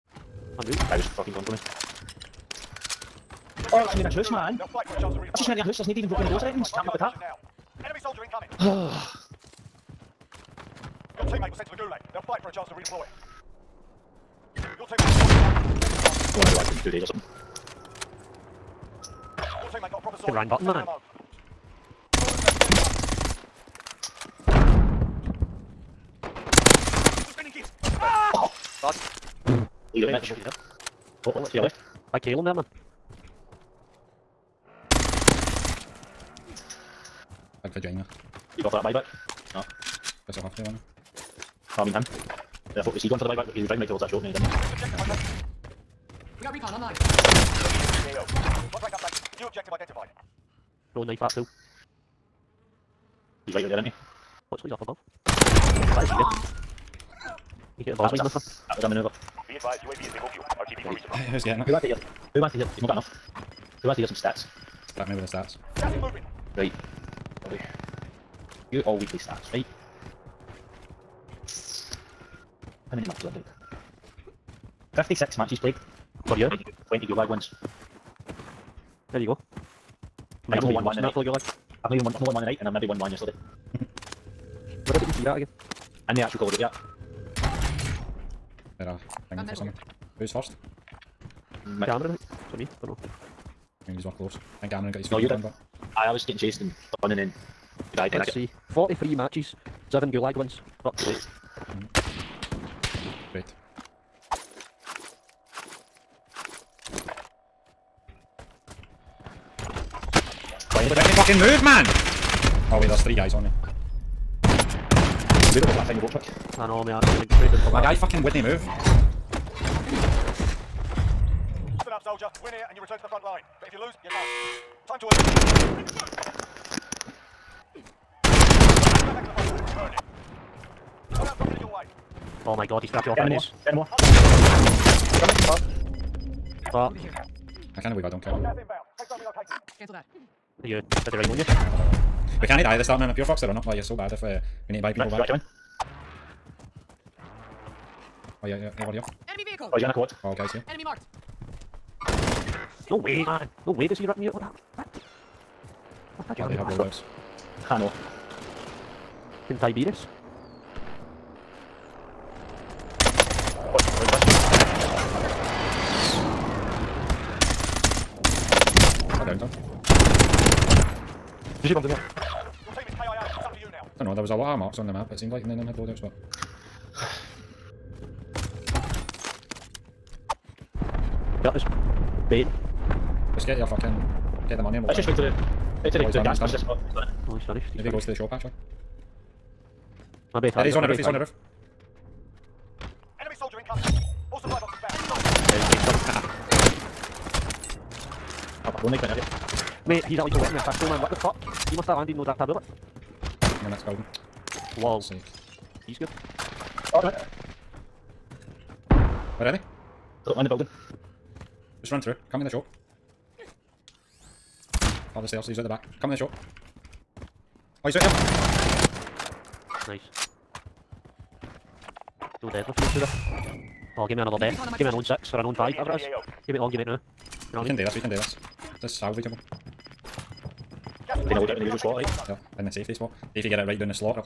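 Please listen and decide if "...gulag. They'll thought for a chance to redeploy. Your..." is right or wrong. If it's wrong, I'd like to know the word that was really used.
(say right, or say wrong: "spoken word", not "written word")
wrong: "fight", not "thought".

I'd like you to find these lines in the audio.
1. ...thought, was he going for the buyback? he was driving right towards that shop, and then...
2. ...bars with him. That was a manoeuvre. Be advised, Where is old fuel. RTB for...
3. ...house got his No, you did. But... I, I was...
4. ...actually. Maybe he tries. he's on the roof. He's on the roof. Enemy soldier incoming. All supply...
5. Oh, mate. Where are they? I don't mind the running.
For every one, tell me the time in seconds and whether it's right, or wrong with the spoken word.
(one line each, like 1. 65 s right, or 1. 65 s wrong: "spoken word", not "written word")
1. 42 s right
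2. 57 s wrong: "UAV", not "Where"
3. 94 s wrong: "close", not "house"
4. 188 s right
5. 206 s wrong: "building", not "running".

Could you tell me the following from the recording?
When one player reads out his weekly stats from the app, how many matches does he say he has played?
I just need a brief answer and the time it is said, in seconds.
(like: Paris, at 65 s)
56, at 74 s.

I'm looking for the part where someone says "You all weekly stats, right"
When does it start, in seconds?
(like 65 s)
68 s.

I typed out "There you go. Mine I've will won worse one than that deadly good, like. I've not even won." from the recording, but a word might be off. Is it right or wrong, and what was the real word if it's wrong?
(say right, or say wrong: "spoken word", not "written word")
wrong: "fully", not "deadly".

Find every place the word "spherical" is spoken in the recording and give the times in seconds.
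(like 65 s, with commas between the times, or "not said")
not said.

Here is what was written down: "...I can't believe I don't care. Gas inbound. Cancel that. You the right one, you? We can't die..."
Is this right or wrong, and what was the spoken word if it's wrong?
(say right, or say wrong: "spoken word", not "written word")
right.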